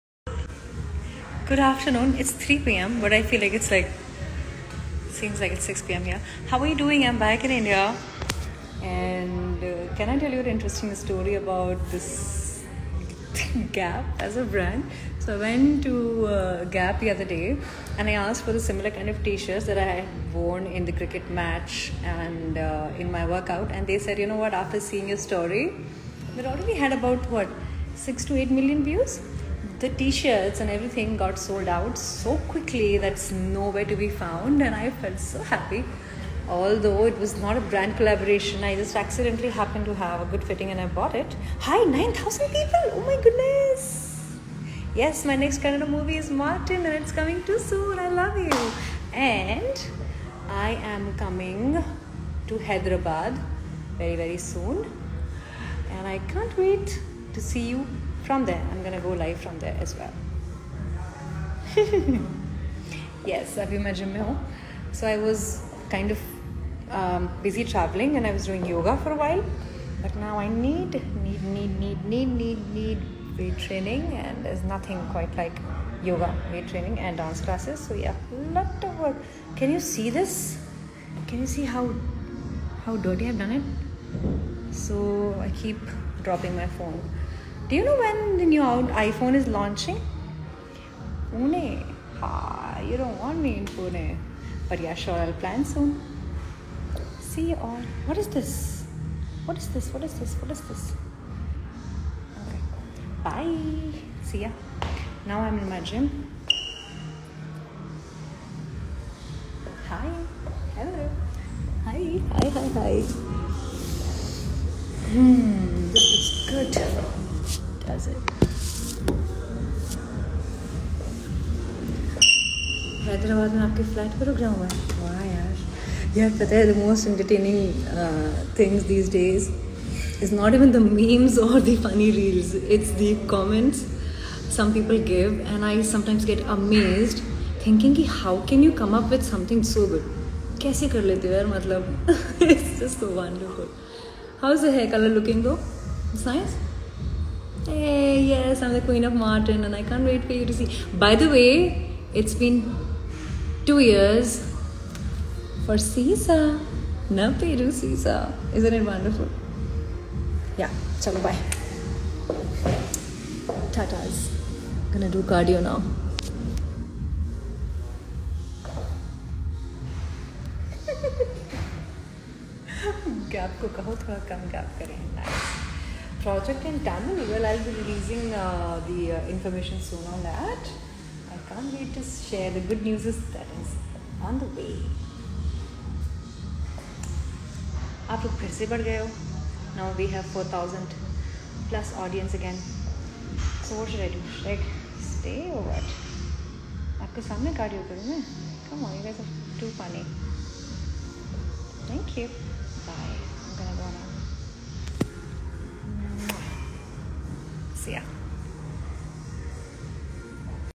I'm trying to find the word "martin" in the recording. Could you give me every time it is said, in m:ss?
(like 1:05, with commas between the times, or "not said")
0:46, 2:29.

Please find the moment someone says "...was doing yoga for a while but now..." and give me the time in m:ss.
1:08.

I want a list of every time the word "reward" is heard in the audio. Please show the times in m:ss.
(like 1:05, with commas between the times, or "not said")
not said.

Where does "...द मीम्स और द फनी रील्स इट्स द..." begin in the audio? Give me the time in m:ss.
2:10.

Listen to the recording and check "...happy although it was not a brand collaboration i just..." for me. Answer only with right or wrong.
right.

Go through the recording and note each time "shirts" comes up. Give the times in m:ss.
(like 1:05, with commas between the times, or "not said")
0:19, 0:29.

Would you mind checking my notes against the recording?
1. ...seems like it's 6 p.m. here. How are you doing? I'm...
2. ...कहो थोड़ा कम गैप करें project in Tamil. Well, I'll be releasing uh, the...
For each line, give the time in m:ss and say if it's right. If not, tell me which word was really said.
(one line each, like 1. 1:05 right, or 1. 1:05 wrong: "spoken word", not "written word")
1. 0:05 right
2. 2:53 right.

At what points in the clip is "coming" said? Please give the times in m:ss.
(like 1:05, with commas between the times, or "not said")
0:47, 0:51.